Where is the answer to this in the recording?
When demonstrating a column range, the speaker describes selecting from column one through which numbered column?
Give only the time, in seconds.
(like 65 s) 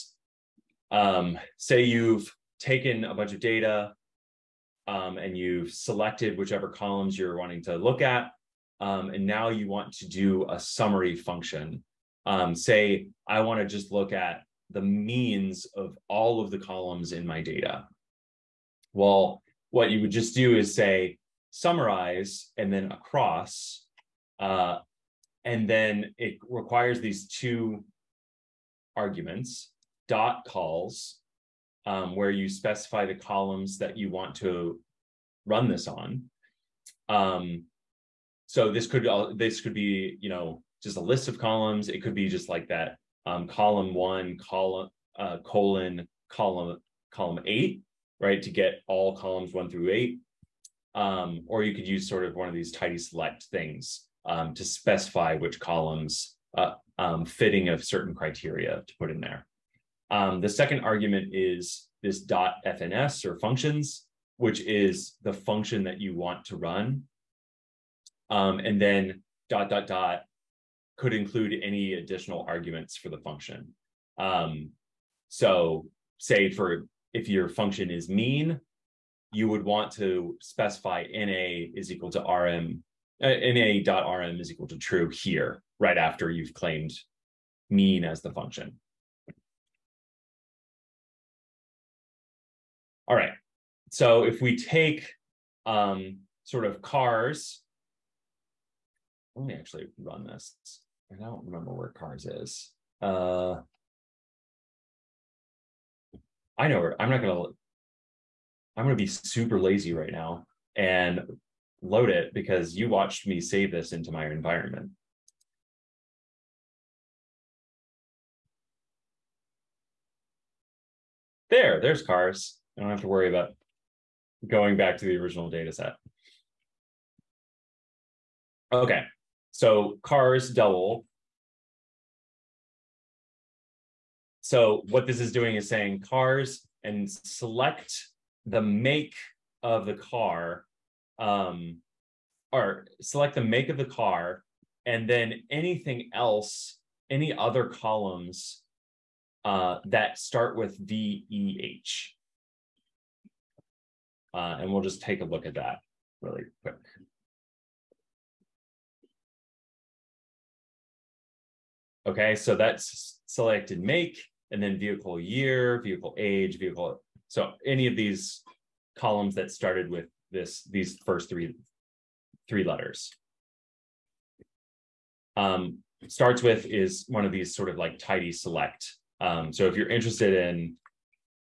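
47 s.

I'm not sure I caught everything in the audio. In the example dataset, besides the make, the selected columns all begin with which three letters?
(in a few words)
VEH.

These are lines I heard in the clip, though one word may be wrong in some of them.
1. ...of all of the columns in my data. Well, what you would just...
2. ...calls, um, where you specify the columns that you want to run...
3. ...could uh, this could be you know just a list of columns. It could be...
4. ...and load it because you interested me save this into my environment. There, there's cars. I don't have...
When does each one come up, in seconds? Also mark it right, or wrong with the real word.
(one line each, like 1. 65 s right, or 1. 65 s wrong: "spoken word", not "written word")
1. 15 s right
2. 30 s right
3. 38 s right
4. 110 s wrong: "watched", not "interested".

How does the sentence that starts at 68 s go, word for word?
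Um, and then dot dot dot could include any additional arguments for the function.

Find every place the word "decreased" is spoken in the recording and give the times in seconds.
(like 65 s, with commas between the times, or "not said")
not said.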